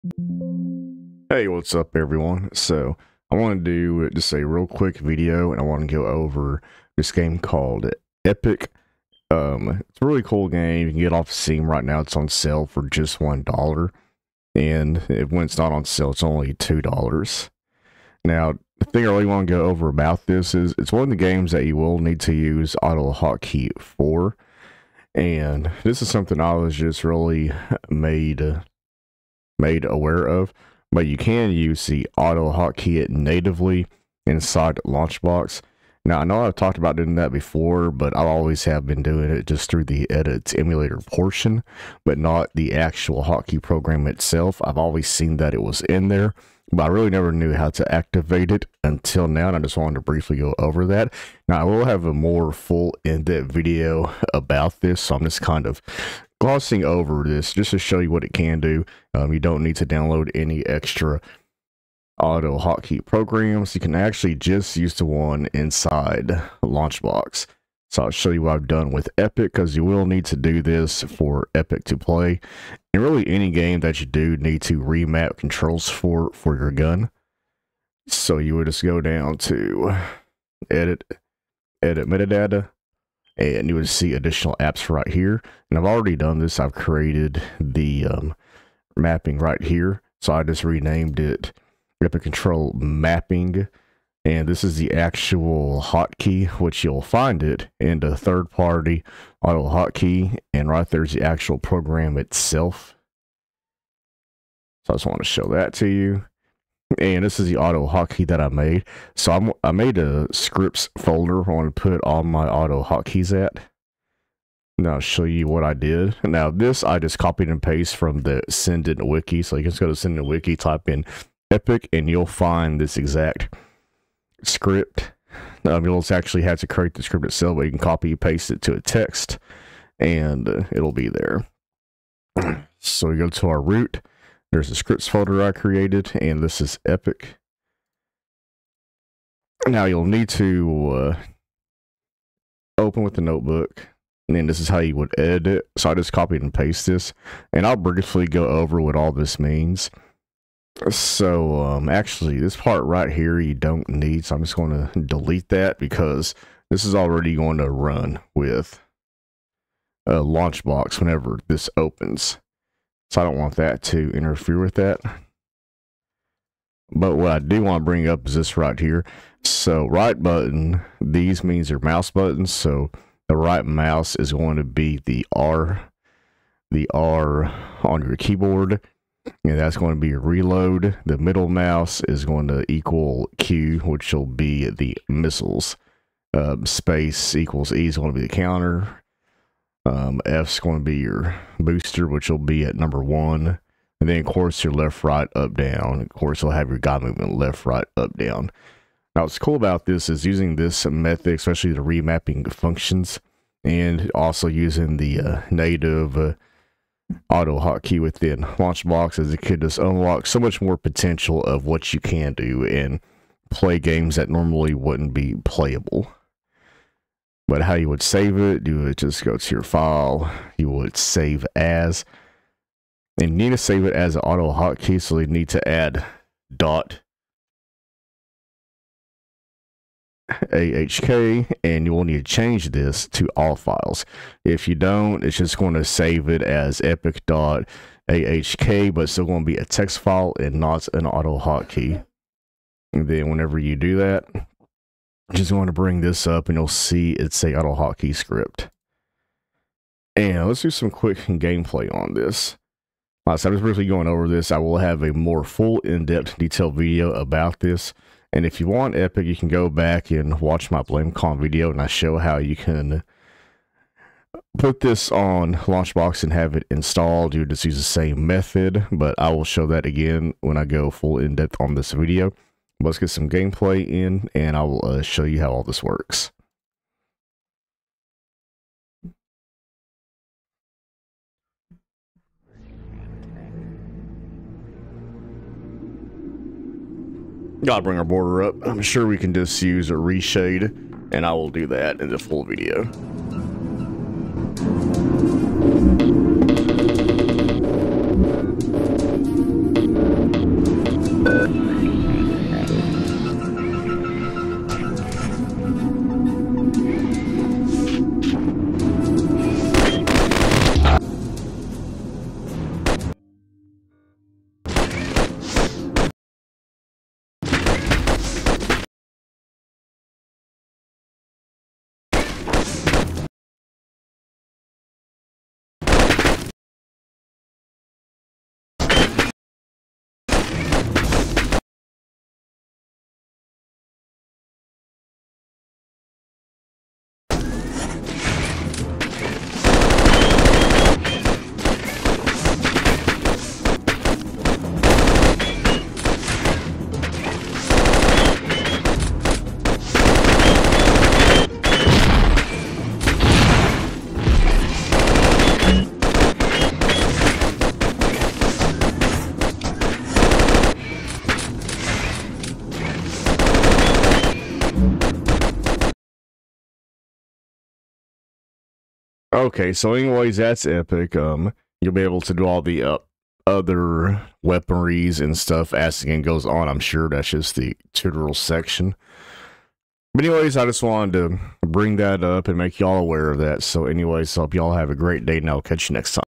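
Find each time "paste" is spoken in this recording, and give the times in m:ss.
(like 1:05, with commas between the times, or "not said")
1:57, 2:08, 2:26.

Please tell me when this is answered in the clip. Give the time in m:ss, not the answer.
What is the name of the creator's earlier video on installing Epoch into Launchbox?
4:20.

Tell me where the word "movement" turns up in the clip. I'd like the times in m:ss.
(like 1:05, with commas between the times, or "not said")
3:17.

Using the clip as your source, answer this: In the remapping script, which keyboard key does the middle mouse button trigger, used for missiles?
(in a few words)
Q.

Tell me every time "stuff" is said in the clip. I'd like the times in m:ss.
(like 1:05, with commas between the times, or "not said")
6:15.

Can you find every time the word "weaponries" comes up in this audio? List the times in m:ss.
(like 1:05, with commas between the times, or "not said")
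6:14.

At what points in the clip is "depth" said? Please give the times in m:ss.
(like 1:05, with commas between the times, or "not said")
0:53, 4:15, 4:31.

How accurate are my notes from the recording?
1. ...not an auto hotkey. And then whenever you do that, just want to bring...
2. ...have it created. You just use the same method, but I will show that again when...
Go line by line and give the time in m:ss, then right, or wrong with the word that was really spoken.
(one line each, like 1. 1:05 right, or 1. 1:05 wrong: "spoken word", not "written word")
1. 4:00 right
2. 4:26 wrong: "installed", not "created".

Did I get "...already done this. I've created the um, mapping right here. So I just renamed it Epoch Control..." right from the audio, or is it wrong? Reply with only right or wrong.
right.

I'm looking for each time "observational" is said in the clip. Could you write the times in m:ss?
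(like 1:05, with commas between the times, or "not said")
not said.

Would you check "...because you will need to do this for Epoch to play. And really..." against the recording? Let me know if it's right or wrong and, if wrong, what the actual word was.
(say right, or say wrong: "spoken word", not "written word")
right.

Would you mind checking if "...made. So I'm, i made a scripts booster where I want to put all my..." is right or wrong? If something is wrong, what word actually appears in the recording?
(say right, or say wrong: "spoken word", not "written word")
wrong: "folder", not "booster".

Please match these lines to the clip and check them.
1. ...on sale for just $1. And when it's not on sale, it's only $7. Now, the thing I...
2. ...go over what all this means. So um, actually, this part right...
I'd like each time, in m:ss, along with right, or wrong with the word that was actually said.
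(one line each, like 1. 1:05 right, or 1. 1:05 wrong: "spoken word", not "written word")
1. 0:12 wrong: "2", not "7"
2. 2:28 right.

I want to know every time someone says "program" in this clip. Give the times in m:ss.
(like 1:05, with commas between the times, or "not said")
0:43, 1:03, 1:41.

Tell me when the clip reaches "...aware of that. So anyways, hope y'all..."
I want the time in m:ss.
6:22.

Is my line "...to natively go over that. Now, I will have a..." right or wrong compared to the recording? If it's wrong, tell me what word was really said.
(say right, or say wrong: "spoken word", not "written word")
wrong: "briefly", not "natively".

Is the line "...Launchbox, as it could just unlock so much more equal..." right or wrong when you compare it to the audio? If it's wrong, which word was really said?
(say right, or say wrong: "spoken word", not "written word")
wrong: "potential", not "equal".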